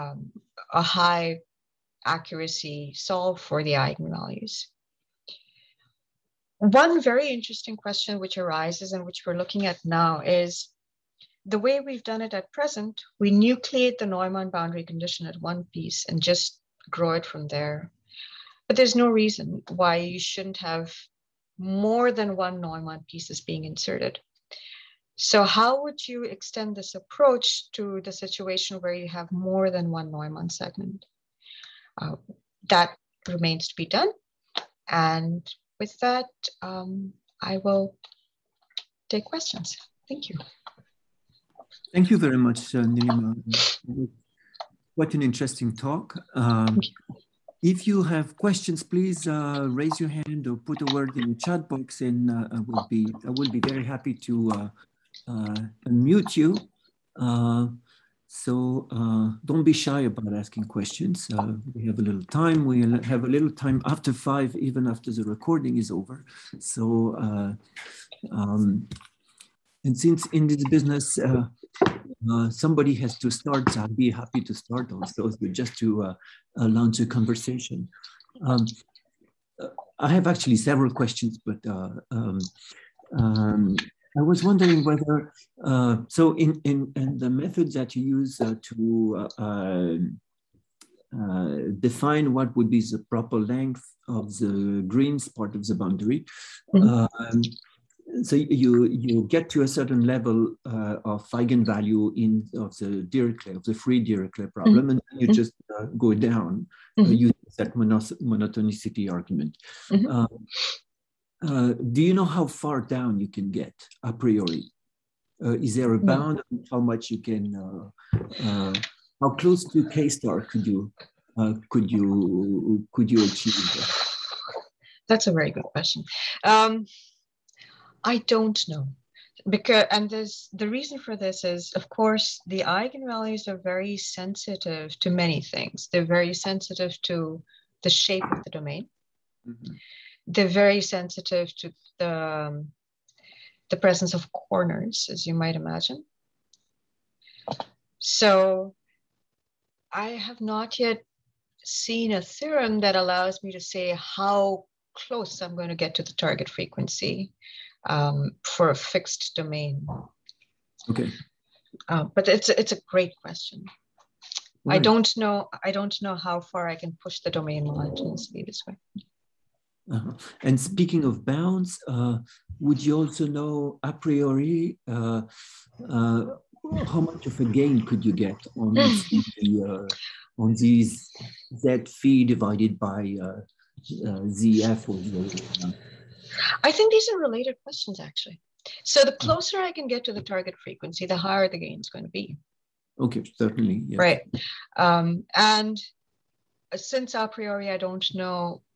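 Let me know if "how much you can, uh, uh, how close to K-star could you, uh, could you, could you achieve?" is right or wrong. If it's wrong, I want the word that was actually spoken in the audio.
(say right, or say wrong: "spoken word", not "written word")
right.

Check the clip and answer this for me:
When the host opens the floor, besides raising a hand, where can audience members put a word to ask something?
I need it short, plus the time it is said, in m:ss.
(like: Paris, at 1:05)
the chat box, at 0:51.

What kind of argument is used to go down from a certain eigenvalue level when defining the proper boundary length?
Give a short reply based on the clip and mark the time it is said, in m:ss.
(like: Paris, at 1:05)
monotonicity argument, at 1:48.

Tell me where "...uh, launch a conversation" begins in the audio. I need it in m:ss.
1:16.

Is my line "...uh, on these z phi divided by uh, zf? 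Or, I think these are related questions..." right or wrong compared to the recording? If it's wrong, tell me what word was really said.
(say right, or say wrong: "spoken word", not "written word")
right.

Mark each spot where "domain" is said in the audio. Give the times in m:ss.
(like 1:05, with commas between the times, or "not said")
2:18, 2:39, 2:47.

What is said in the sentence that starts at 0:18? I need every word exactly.
But there's no reason why you shouldn't have more than one Neumann pieces being inserted.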